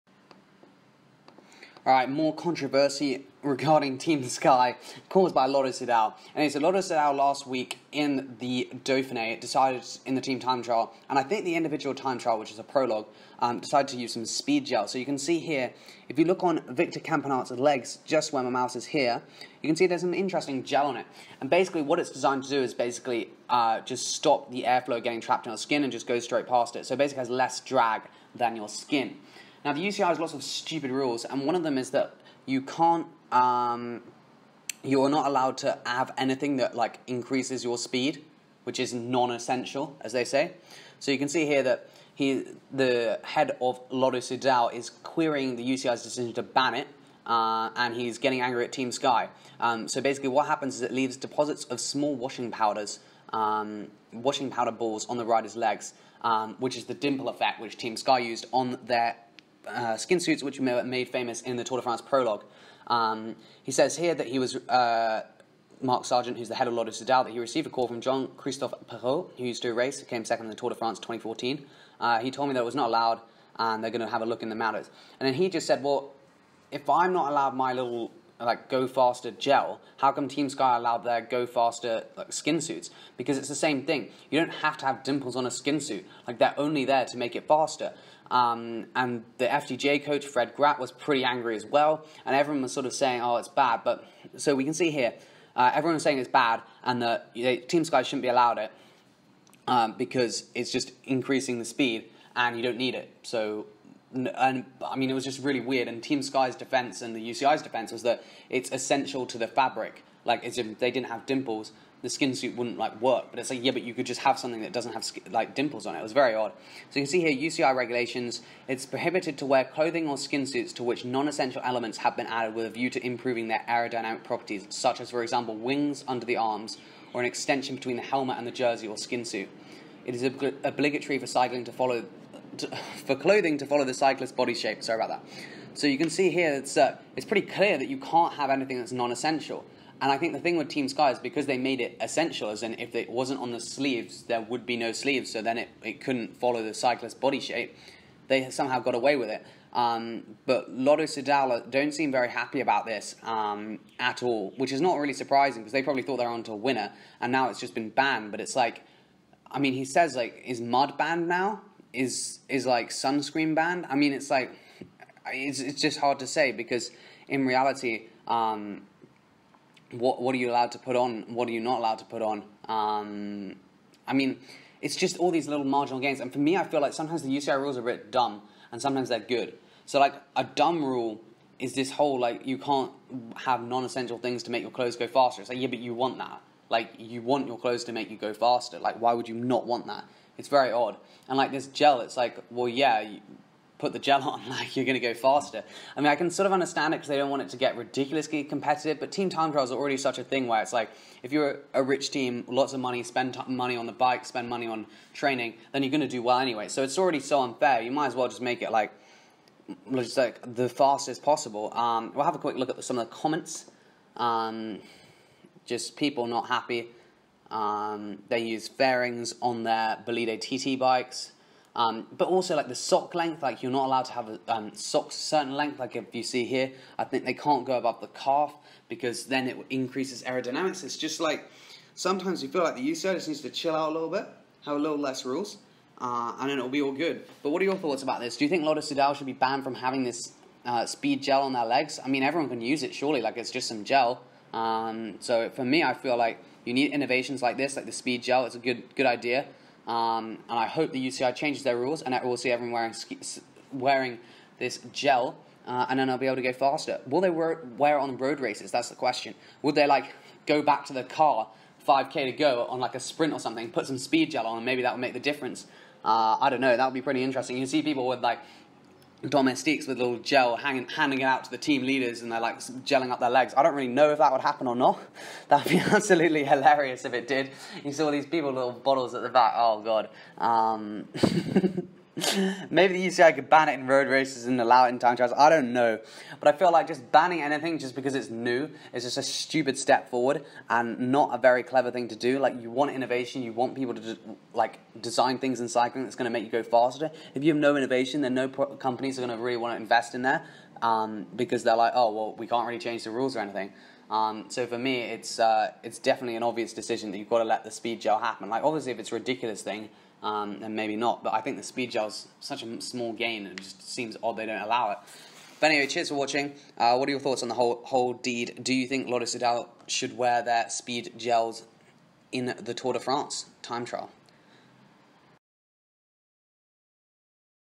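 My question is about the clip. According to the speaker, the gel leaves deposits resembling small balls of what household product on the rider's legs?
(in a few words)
washing powder.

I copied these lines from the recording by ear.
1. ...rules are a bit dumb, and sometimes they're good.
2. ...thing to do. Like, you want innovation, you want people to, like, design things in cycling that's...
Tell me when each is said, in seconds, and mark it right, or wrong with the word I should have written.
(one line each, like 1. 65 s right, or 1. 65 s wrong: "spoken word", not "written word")
1. 177 s right
2. 291 s right.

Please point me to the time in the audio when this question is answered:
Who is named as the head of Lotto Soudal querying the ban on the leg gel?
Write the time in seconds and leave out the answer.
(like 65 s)
65 s.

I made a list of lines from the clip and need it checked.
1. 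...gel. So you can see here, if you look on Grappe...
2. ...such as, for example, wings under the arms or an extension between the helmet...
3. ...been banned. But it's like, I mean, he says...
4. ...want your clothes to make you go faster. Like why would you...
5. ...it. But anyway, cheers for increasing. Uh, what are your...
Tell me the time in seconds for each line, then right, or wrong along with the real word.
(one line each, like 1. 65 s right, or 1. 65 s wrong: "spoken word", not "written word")
1. 14 s wrong: "Victor", not "Grappe"
2. 124 s right
3. 157 s right
4. 187 s right
5. 314 s wrong: "watching", not "increasing".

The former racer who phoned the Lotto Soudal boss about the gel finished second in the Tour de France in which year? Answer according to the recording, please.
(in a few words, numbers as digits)
2014.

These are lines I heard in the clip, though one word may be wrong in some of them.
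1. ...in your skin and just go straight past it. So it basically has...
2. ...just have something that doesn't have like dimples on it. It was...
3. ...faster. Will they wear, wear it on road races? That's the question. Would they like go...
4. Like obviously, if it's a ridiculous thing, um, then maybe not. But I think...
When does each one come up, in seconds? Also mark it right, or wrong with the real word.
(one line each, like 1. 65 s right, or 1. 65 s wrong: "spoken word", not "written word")
1. 25 s right
2. 114 s right
3. 256 s right
4. 308 s right.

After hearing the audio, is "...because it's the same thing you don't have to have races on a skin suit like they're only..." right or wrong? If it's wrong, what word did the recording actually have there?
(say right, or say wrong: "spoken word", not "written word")
wrong: "dimples", not "races".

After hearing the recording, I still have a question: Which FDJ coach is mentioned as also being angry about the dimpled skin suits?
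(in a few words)
Fred Grappe.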